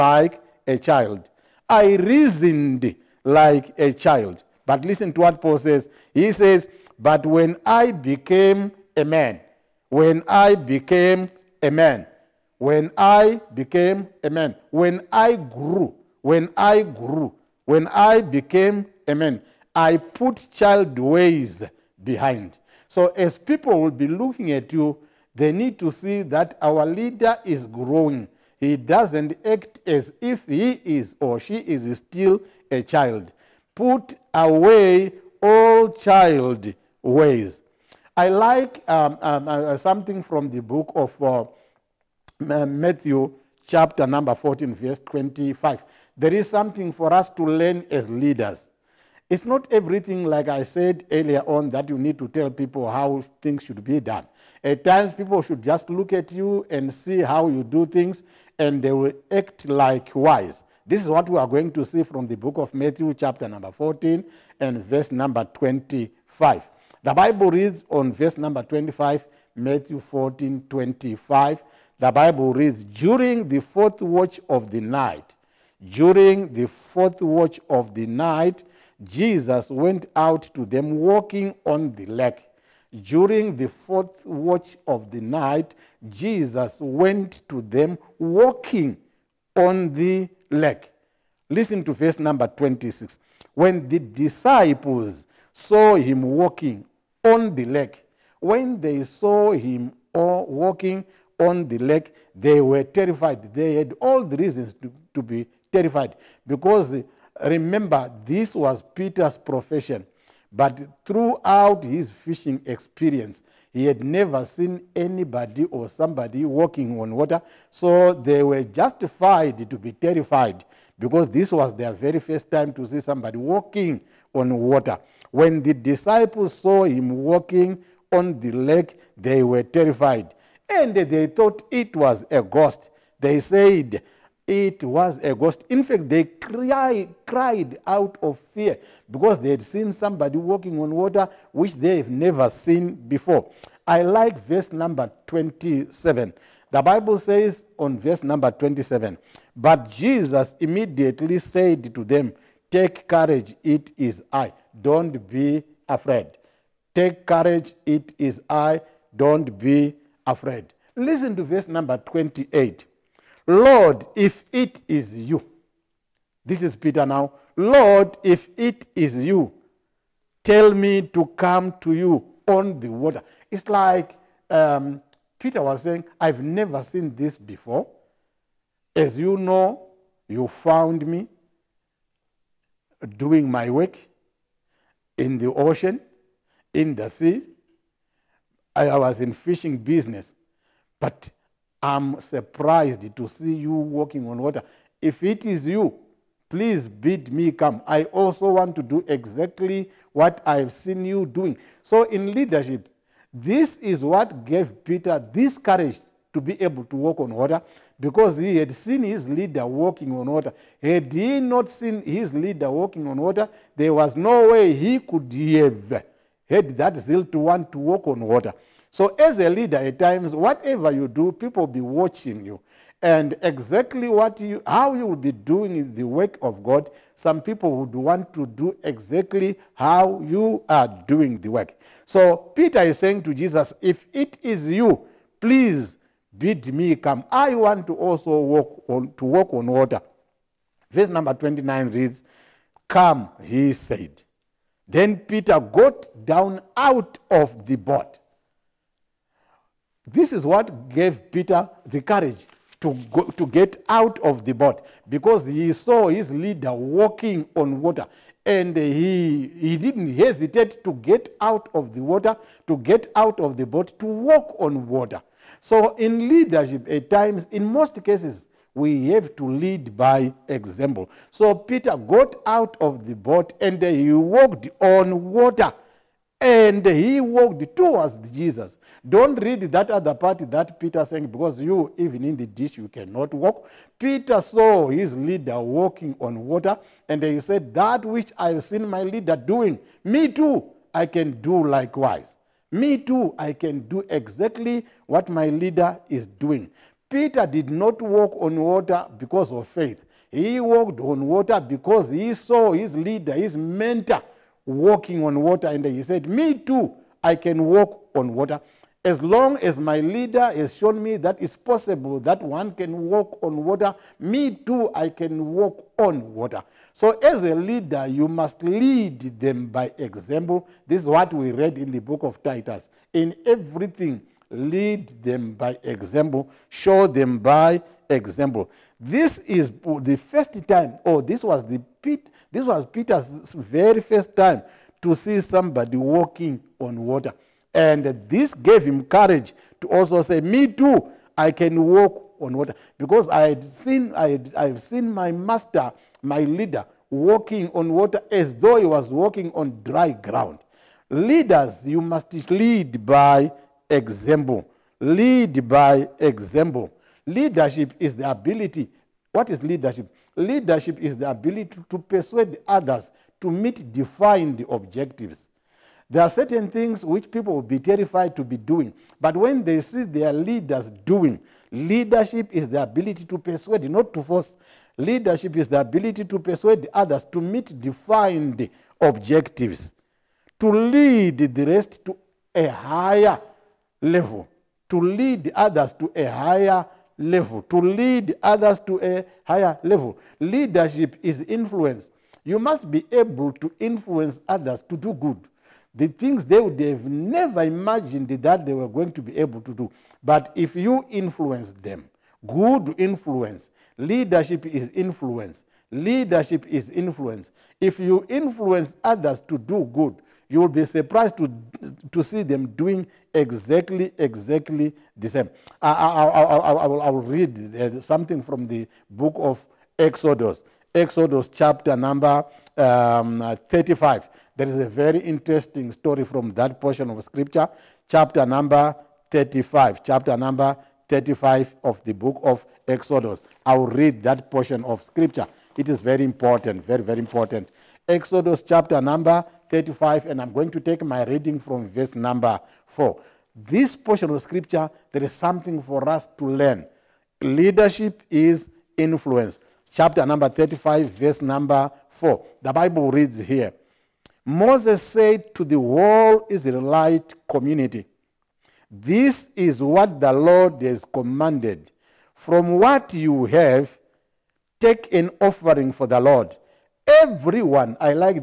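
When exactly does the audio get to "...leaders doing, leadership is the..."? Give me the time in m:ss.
6:10.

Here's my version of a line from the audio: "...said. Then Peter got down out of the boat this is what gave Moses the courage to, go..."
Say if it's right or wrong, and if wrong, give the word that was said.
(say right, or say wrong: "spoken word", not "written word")
wrong: "Peter", not "Moses".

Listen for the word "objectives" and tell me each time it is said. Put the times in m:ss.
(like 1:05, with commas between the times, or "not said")
6:04, 6:18.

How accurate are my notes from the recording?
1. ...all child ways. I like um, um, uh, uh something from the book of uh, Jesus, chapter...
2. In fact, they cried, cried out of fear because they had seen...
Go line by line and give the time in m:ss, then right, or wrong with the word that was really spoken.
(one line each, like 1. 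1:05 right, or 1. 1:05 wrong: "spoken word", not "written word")
1. 0:35 wrong: "Matthew", not "Jesus"
2. 2:15 right.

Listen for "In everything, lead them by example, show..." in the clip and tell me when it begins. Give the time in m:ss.
5:23.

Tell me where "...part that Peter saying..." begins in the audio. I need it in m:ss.
4:40.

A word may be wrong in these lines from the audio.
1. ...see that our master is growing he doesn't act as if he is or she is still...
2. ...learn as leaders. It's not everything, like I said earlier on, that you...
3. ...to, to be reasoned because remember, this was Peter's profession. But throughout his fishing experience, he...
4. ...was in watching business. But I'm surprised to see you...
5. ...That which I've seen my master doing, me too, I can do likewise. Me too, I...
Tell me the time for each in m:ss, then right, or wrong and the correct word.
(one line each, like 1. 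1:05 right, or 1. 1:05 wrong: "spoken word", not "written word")
1. 0:25 wrong: "leader", not "master"
2. 0:47 right
3. 1:44 wrong: "terrified", not "reasoned"
4. 3:08 wrong: "fishing", not "watching"
5. 4:47 wrong: "leader", not "master".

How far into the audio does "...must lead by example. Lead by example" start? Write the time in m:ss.
5:52.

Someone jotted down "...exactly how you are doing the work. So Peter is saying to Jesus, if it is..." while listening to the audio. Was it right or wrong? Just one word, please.
right.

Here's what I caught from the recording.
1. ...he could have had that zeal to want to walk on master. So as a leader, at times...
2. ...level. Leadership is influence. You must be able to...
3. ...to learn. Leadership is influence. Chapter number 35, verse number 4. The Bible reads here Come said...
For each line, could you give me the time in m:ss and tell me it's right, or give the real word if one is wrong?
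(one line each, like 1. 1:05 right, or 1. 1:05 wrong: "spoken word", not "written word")
1. 3:34 wrong: "water", not "master"
2. 6:29 right
3. 7:26 wrong: "Moses", not "Come".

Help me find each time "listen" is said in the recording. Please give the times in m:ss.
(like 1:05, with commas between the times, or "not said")
0:04, 1:31, 2:40.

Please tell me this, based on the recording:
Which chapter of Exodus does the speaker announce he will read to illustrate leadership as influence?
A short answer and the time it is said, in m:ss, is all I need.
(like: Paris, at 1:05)
35, at 7:00.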